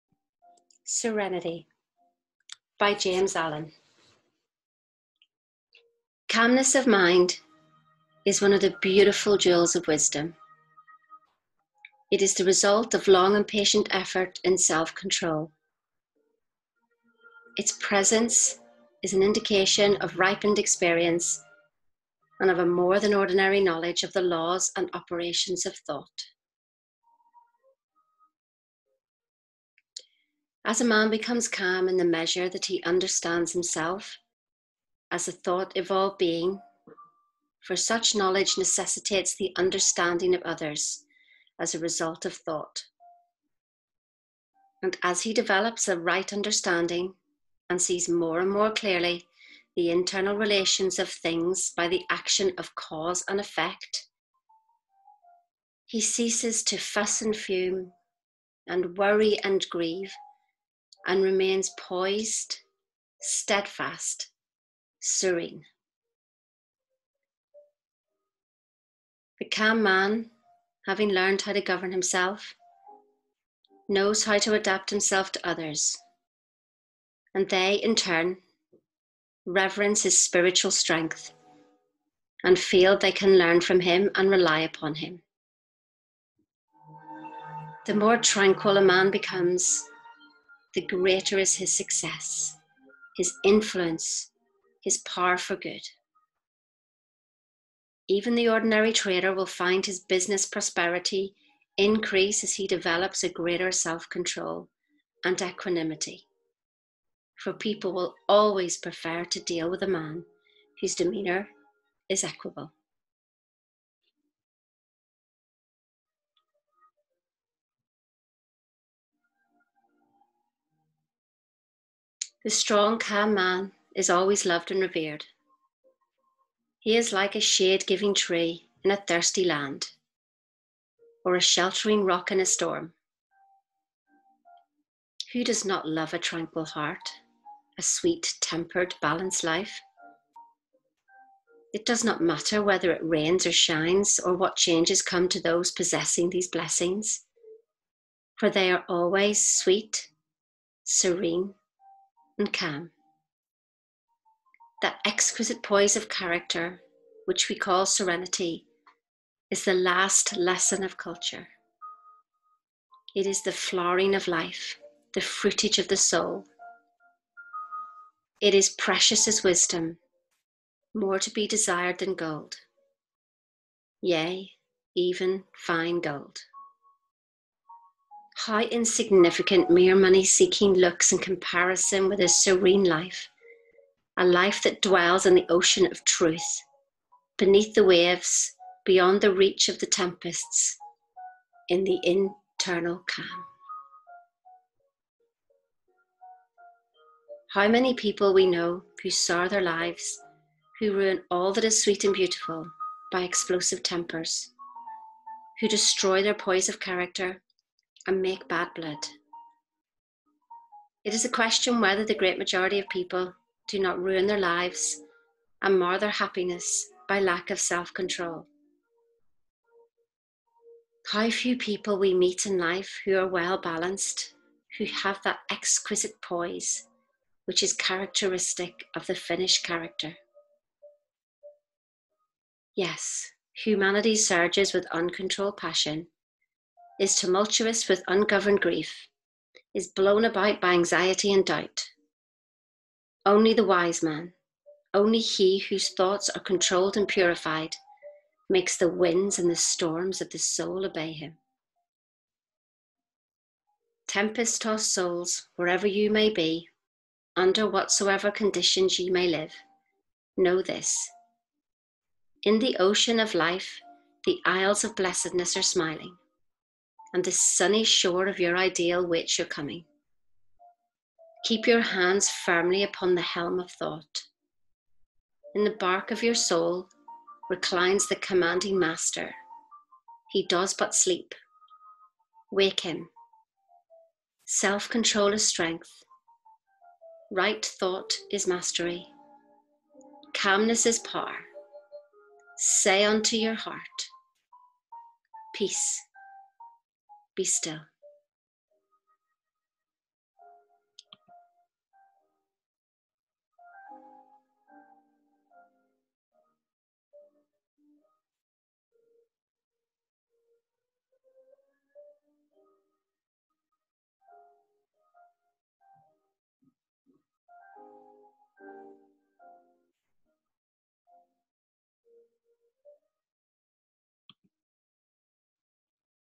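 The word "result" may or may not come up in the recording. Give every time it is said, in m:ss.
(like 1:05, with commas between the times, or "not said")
0:12, 0:41.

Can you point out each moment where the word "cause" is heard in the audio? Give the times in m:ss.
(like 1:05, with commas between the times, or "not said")
0:52.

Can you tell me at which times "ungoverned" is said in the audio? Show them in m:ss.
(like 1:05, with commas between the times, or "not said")
3:58.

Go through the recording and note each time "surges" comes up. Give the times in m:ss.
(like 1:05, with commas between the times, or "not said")
3:54.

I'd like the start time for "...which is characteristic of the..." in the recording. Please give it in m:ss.
3:47.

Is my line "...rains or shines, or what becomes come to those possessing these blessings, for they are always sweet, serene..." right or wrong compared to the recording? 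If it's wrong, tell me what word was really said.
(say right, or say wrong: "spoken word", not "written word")
wrong: "changes", not "becomes".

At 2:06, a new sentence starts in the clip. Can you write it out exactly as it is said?
He is like a shade giving tree in a thirsty land, or a sheltering rock in a storm.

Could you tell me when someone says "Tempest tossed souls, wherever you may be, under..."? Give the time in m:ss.
4:14.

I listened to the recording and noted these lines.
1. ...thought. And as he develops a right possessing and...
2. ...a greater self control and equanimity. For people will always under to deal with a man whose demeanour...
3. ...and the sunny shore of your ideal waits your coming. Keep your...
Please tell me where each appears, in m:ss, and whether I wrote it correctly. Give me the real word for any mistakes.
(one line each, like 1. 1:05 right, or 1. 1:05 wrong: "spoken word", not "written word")
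1. 0:42 wrong: "understanding", not "possessing"
2. 1:43 wrong: "prefer", not "under"
3. 4:27 right.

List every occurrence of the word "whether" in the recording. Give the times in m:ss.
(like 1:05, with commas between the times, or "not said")
2:22, 3:31.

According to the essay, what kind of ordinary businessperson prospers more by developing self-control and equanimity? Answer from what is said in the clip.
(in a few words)
the ordinary trader.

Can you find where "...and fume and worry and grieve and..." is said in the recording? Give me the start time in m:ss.
0:57.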